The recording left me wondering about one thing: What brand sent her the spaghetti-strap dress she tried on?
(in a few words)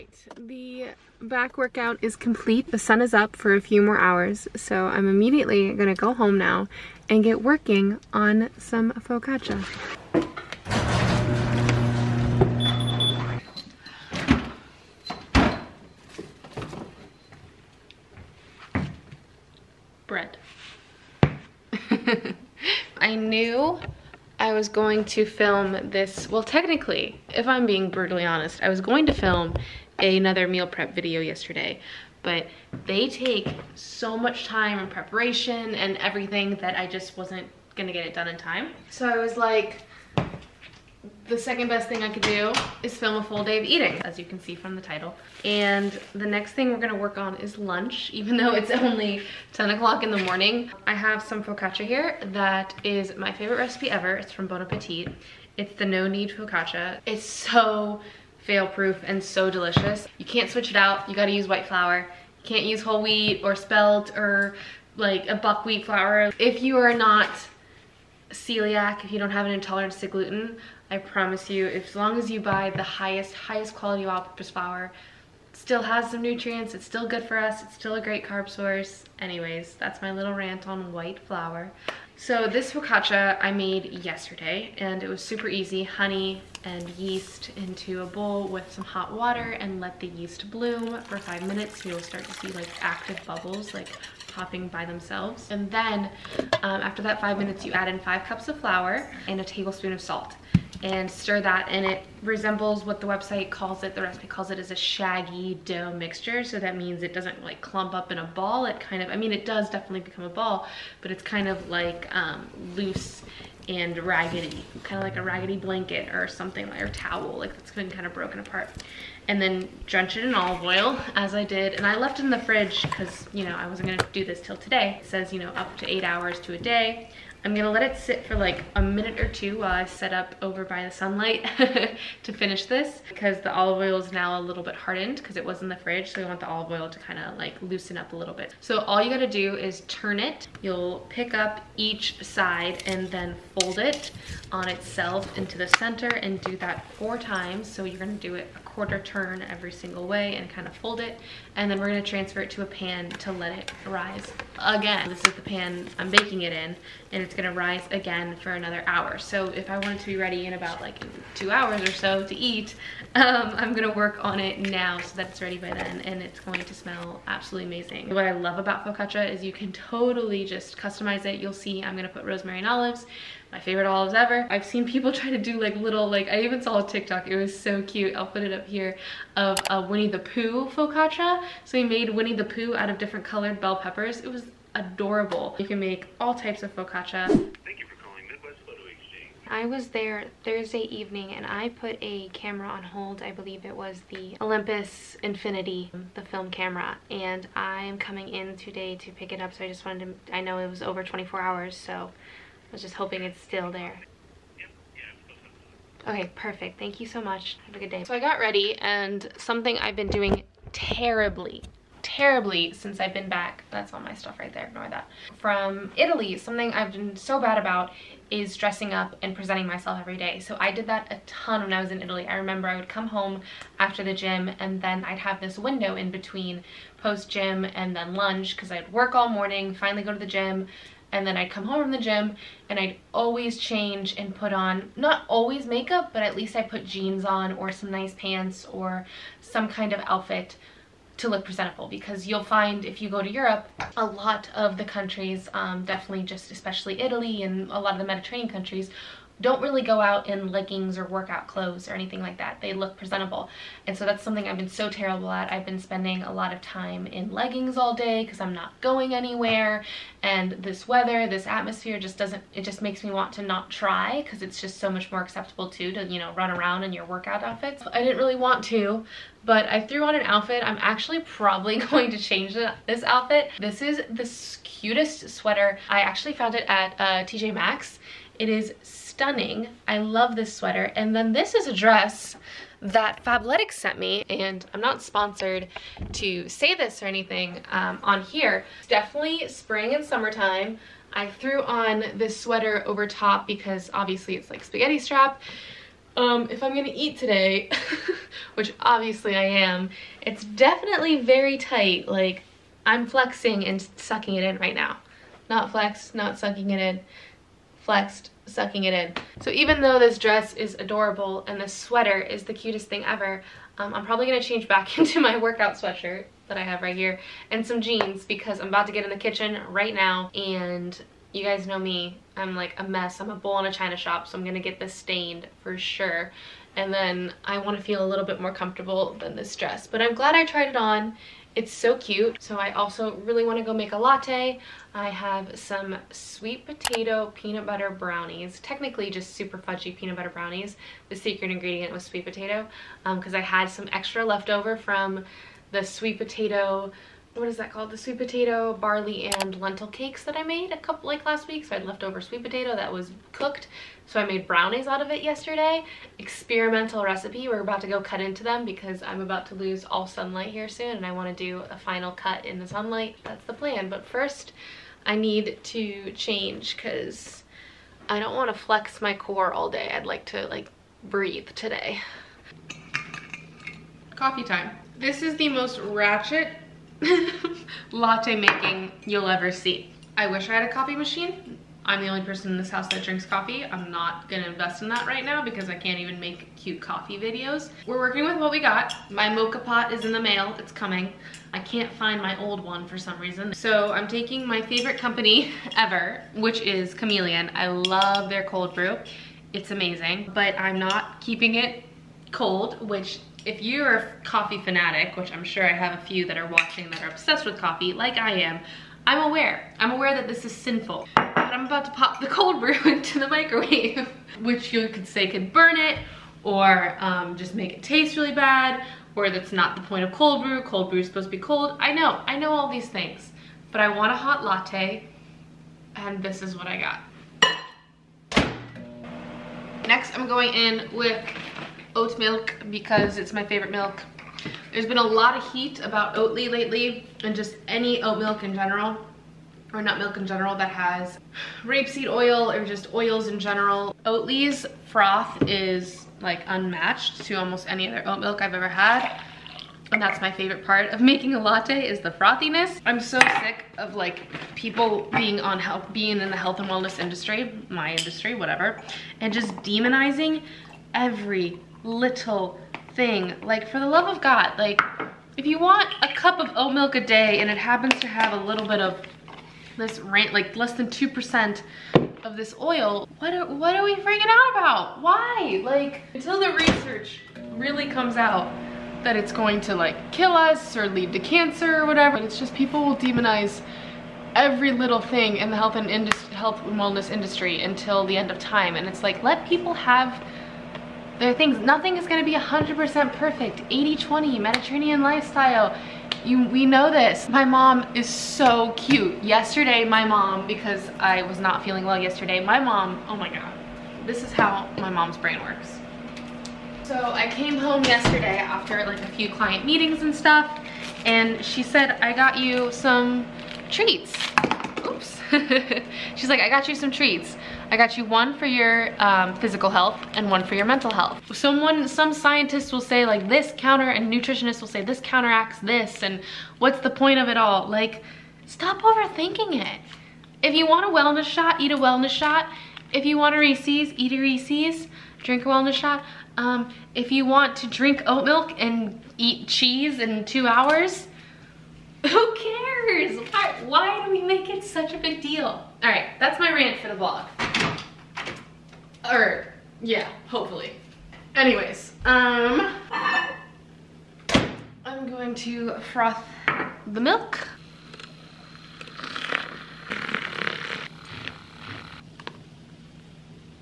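Fabletics.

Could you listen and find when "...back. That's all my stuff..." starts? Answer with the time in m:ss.
3:33.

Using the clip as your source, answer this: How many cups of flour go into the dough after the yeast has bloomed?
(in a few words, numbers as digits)
5.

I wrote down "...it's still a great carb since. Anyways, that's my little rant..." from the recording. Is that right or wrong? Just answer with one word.
wrong.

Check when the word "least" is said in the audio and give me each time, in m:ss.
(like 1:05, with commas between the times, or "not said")
3:56.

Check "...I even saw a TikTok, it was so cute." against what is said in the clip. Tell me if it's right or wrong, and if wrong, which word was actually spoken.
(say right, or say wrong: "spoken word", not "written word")
right.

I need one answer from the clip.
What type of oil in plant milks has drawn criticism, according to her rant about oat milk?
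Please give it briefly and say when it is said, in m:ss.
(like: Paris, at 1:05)
rapeseed oil, at 7:21.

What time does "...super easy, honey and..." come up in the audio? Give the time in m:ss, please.
1:25.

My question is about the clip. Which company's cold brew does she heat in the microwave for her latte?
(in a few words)
Chameleon.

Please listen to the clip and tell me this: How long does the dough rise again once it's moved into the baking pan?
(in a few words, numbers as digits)
another hour.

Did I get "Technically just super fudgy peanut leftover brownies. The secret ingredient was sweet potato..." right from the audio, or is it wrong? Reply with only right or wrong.
wrong.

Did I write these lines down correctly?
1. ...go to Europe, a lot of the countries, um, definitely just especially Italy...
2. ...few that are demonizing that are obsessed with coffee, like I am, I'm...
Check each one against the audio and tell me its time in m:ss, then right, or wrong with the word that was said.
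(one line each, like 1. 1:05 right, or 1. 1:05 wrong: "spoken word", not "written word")
1. 4:03 right
2. 6:46 wrong: "watching", not "demonizing".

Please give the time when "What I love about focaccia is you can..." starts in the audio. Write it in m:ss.
2:48.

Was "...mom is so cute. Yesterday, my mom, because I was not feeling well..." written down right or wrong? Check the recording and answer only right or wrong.
right.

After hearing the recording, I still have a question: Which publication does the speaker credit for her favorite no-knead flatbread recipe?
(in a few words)
Bon Appetit.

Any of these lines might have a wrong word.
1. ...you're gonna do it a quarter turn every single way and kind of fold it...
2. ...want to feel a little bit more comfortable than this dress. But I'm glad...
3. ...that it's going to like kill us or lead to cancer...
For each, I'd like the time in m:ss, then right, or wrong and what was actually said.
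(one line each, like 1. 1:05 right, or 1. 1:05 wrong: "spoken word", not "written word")
1. 2:27 right
2. 5:27 right
3. 7:59 right.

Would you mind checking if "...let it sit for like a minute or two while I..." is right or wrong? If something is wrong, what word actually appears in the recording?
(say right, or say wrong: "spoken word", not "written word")
right.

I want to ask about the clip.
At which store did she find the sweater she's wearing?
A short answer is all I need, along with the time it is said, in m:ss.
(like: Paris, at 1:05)
TJ Maxx, at 4:37.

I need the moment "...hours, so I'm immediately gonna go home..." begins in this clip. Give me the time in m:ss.
0:03.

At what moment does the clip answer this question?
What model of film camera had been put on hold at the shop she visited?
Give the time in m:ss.
3:14.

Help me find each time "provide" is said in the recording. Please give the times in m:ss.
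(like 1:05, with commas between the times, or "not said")
not said.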